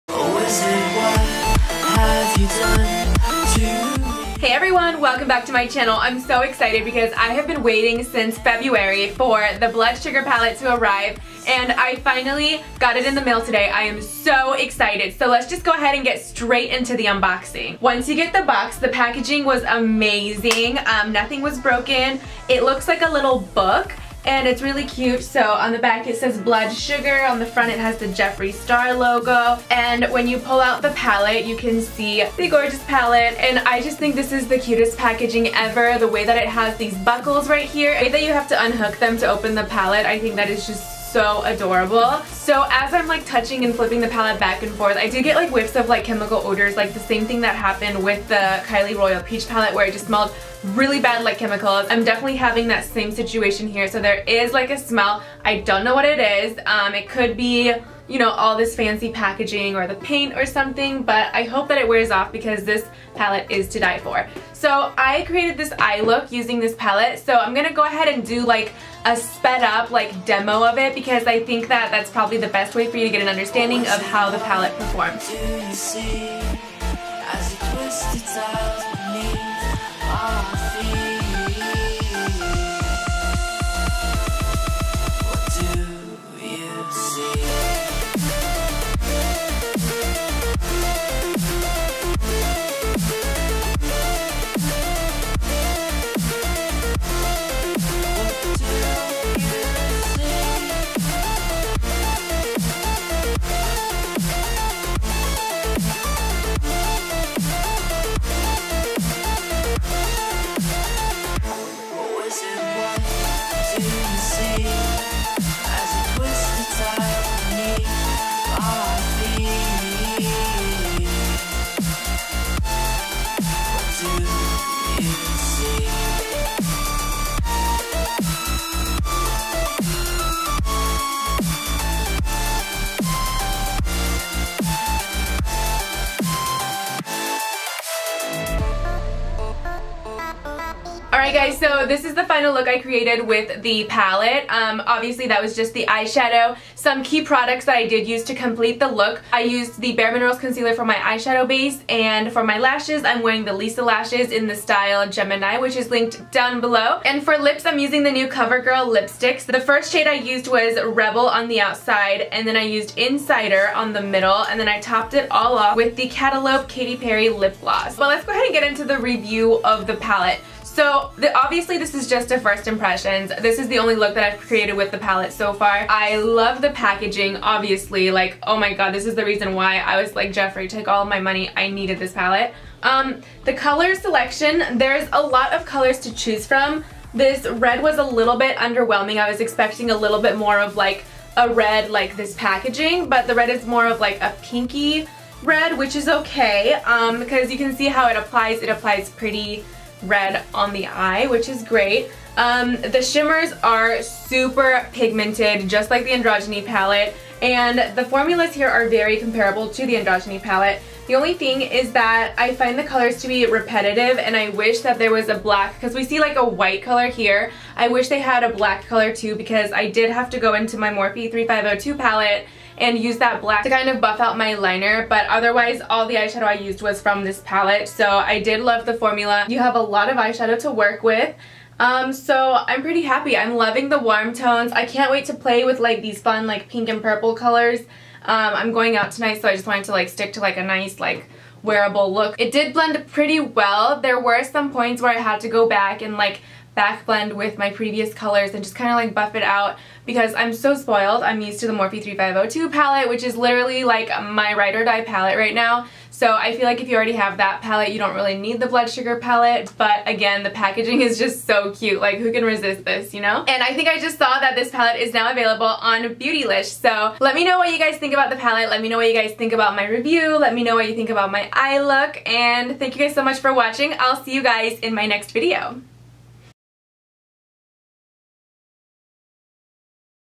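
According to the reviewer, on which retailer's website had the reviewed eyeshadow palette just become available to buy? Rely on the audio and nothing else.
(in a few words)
Beautylish.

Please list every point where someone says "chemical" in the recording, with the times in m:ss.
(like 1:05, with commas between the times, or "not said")
0:46, 0:51.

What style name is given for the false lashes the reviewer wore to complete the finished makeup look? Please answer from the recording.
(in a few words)
Gemini.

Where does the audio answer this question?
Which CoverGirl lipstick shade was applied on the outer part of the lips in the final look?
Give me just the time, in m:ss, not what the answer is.
2:40.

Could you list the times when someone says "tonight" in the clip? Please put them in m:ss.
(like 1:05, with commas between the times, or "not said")
3:59.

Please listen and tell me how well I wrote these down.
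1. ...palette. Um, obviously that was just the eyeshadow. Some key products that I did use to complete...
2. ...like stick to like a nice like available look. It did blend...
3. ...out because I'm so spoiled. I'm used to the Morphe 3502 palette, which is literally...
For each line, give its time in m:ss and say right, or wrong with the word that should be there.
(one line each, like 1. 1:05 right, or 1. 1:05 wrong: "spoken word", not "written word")
1. 2:23 right
2. 3:59 wrong: "wearable", not "available"
3. 4:09 right.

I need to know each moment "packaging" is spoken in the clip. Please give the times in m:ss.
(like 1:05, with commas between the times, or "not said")
0:18, 0:34, 0:59, 2:56, 3:12, 4:20.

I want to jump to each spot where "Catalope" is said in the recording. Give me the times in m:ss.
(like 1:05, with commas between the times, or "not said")
2:46.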